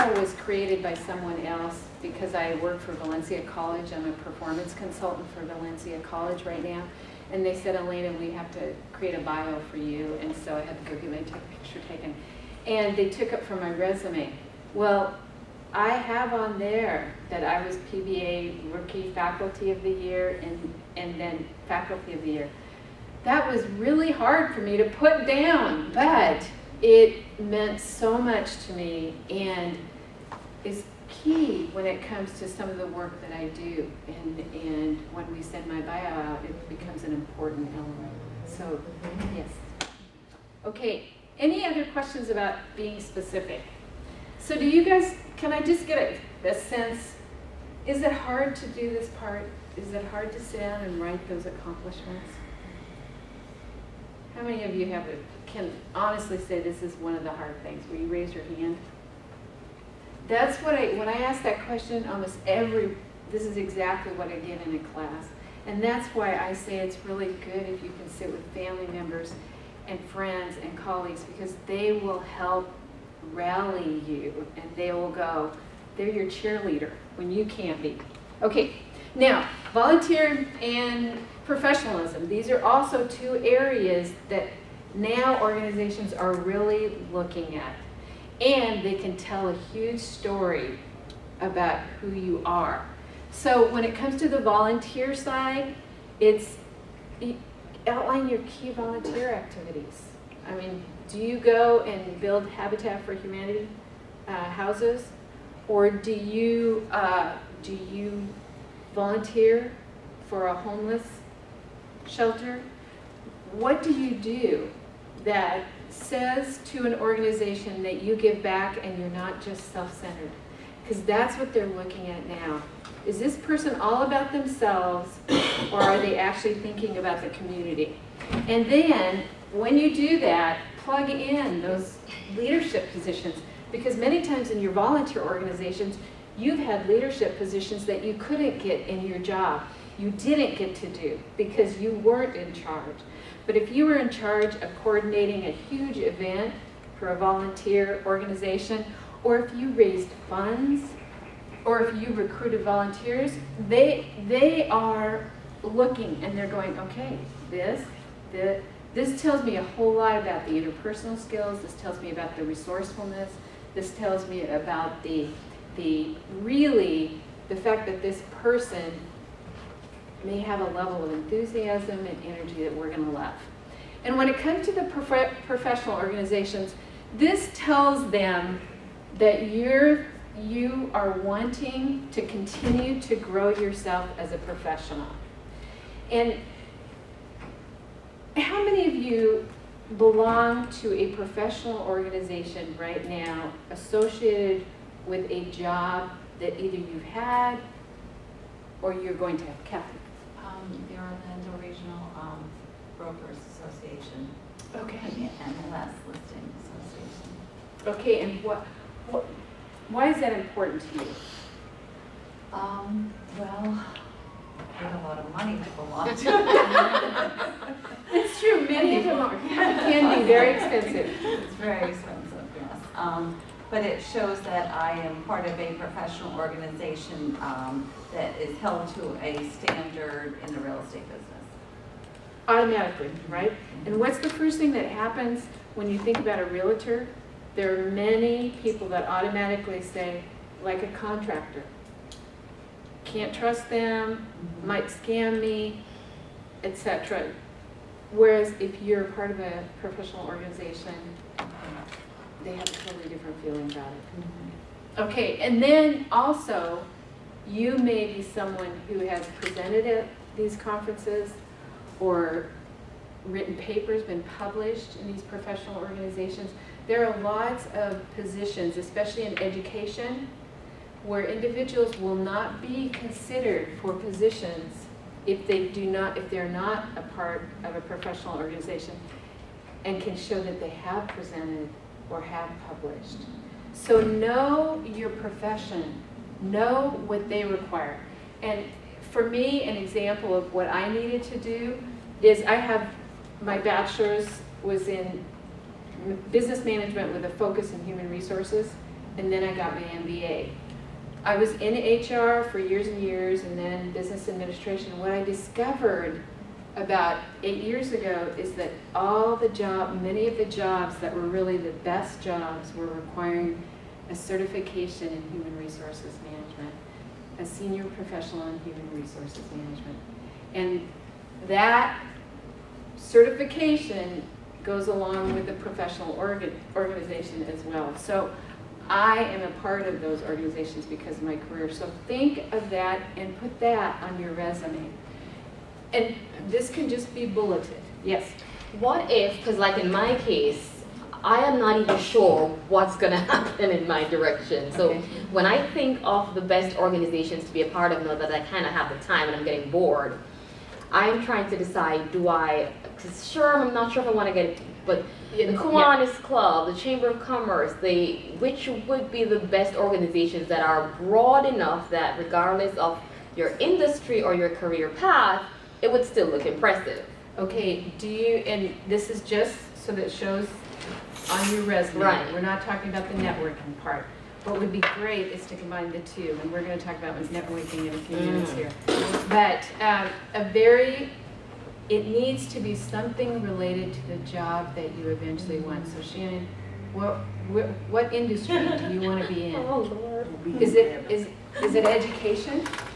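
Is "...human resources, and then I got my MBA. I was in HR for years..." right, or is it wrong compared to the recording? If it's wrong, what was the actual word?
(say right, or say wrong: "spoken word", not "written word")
right.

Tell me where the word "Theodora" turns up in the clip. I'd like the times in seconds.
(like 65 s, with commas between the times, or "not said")
not said.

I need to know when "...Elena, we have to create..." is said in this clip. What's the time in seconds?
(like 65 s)
7 s.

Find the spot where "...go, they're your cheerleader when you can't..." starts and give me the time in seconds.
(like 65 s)
75 s.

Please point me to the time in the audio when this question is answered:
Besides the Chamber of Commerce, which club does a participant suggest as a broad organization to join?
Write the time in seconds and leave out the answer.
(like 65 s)
355 s.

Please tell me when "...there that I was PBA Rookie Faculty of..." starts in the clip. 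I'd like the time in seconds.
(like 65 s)
16 s.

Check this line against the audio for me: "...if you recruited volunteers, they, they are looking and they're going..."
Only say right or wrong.
right.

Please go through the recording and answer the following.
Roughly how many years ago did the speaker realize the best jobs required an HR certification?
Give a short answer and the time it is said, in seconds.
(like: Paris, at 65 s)
8, at 307 s.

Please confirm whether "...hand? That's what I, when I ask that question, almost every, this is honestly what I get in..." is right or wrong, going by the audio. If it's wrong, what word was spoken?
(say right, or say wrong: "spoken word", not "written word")
wrong: "exactly", not "honestly".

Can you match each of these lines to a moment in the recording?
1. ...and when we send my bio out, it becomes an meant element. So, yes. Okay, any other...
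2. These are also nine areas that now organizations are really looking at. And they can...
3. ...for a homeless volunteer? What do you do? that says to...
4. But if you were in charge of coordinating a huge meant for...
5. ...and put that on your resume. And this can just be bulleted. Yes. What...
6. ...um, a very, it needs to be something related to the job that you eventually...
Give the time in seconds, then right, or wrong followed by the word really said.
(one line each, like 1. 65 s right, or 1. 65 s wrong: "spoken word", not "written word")
1. 34 s wrong: "important", not "meant"
2. 82 s wrong: "two", not "nine"
3. 110 s wrong: "shelter", not "volunteer"
4. 143 s wrong: "event", not "meant"
5. 333 s right
6. 379 s right.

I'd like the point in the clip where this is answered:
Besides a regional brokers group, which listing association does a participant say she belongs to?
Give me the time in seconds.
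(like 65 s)
204 s.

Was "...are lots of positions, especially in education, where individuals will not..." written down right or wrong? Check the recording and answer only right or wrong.
right.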